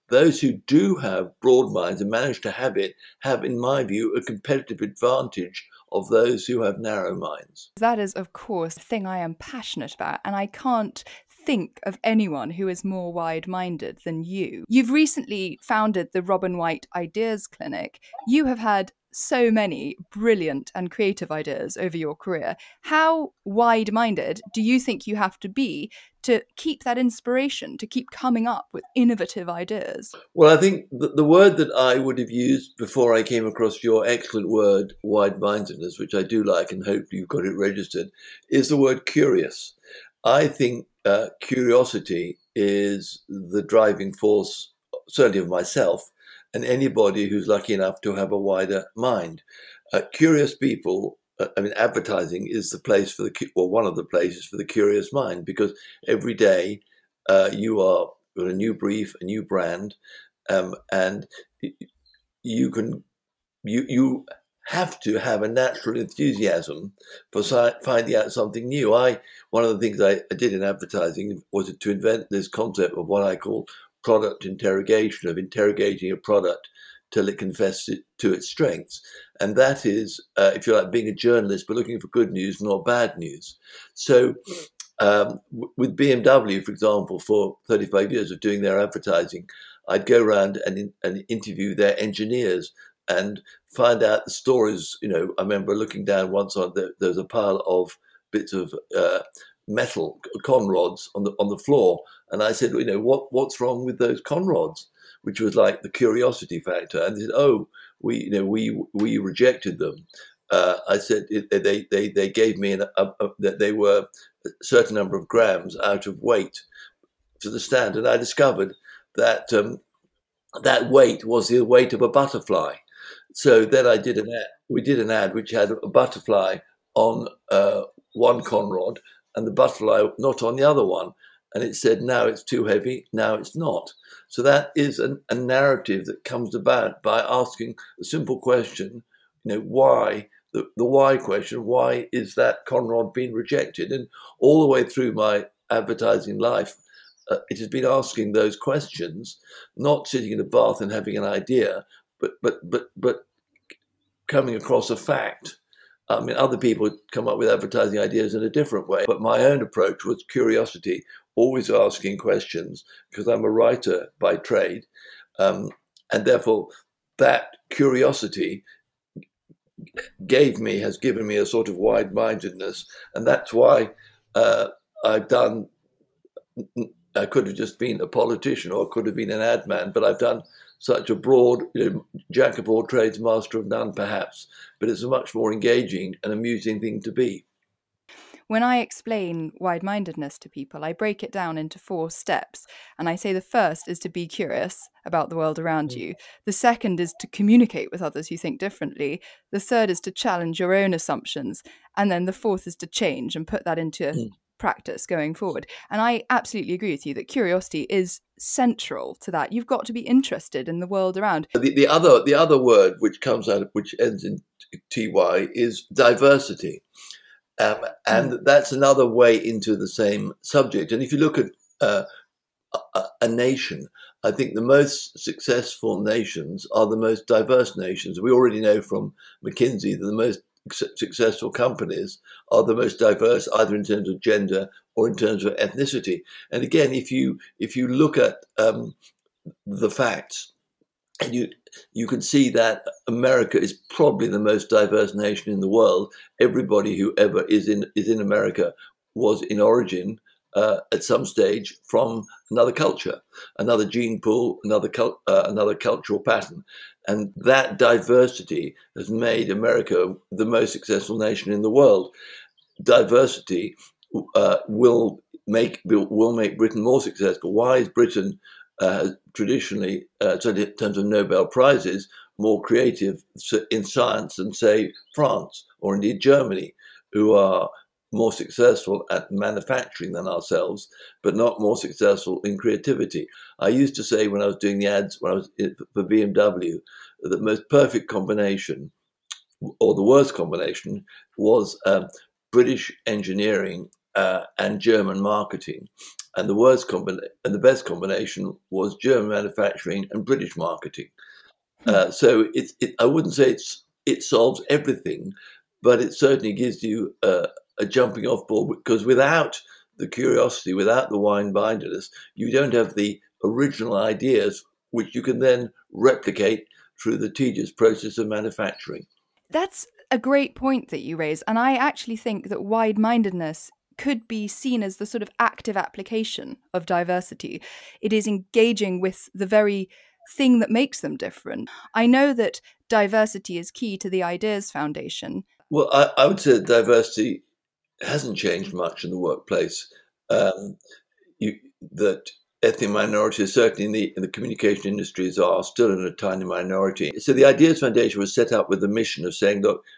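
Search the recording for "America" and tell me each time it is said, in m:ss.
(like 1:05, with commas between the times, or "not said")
4:03, 4:08, 4:19.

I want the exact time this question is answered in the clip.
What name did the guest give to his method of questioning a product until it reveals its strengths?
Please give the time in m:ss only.
1:14.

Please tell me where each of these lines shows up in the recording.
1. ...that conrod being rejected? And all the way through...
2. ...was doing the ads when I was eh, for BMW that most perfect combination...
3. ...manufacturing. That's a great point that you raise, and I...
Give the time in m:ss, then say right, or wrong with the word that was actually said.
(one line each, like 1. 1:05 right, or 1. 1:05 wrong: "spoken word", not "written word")
1. 2:22 right
2. 4:44 right
3. 5:18 right.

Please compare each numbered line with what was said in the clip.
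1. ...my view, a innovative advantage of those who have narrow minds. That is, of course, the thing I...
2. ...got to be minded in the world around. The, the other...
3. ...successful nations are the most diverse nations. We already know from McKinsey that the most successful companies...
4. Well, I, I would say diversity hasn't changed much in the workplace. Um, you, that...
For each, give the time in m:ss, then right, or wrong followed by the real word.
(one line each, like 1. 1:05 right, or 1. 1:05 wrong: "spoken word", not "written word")
1. 0:03 wrong: "competitive", not "innovative"
2. 3:29 wrong: "interested", not "minded"
3. 3:45 right
4. 5:35 right.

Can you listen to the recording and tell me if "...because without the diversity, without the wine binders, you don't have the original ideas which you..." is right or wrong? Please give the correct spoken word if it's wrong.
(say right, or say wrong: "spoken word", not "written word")
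wrong: "curiosity", not "diversity".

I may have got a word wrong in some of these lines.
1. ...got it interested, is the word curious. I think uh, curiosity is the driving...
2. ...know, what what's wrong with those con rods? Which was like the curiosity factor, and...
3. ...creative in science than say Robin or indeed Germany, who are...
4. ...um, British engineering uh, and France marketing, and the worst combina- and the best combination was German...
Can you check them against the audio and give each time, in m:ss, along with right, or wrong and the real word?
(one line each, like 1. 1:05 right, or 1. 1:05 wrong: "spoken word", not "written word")
1. 0:37 wrong: "registered", not "interested"
2. 1:42 right
3. 4:32 wrong: "France", not "Robin"
4. 4:51 wrong: "German", not "France".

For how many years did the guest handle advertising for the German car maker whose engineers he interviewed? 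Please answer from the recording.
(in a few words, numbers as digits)
35.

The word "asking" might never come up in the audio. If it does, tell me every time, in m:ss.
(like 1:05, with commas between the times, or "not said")
2:17, 2:27, 2:41.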